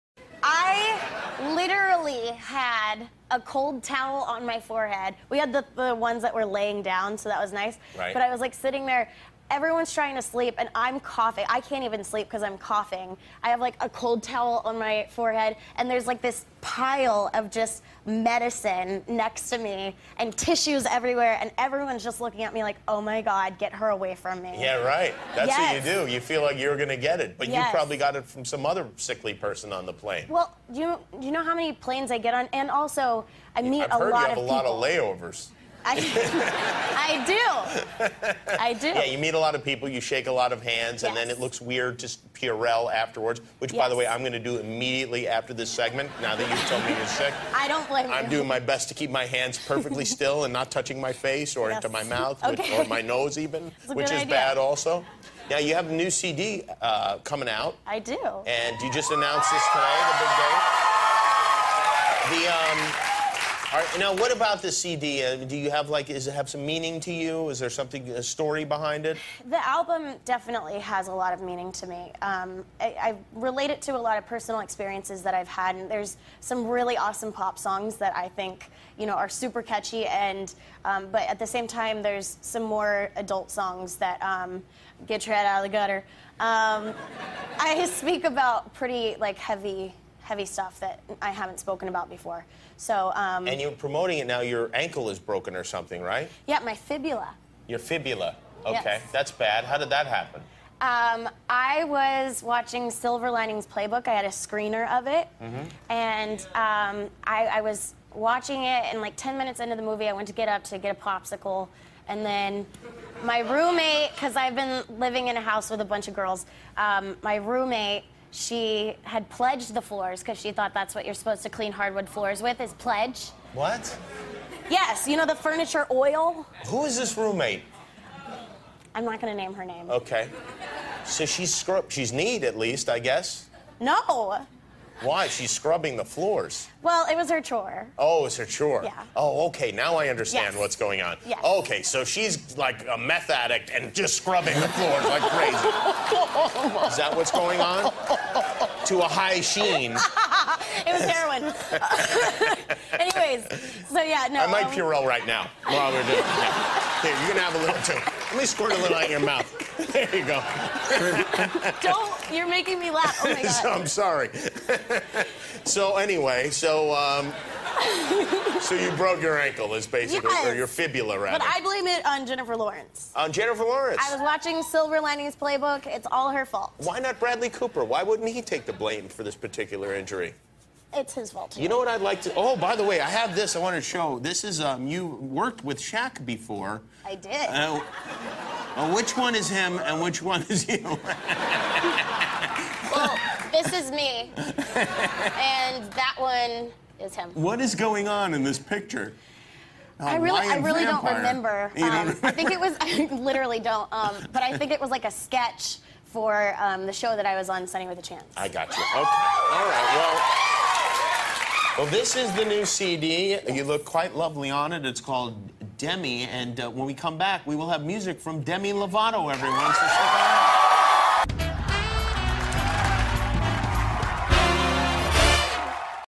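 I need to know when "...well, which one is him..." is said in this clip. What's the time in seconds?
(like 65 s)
188 s.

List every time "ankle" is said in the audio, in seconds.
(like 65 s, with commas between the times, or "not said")
94 s, 169 s.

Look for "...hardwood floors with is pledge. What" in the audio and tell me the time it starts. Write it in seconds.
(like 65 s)
121 s.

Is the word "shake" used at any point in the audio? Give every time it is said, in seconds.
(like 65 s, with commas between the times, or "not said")
40 s.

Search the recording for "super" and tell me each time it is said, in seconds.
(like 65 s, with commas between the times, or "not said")
79 s.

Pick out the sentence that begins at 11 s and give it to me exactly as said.
I can't even sleep because I'm coughing.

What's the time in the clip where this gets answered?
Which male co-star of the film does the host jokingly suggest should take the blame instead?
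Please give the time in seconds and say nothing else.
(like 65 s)
177 s.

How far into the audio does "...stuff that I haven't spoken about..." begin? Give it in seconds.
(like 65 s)
90 s.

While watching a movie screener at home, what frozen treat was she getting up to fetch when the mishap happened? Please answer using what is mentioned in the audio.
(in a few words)
popsicle.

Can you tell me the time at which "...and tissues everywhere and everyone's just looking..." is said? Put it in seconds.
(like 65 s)
20 s.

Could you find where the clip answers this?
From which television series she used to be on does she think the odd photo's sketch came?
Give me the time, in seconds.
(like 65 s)
207 s.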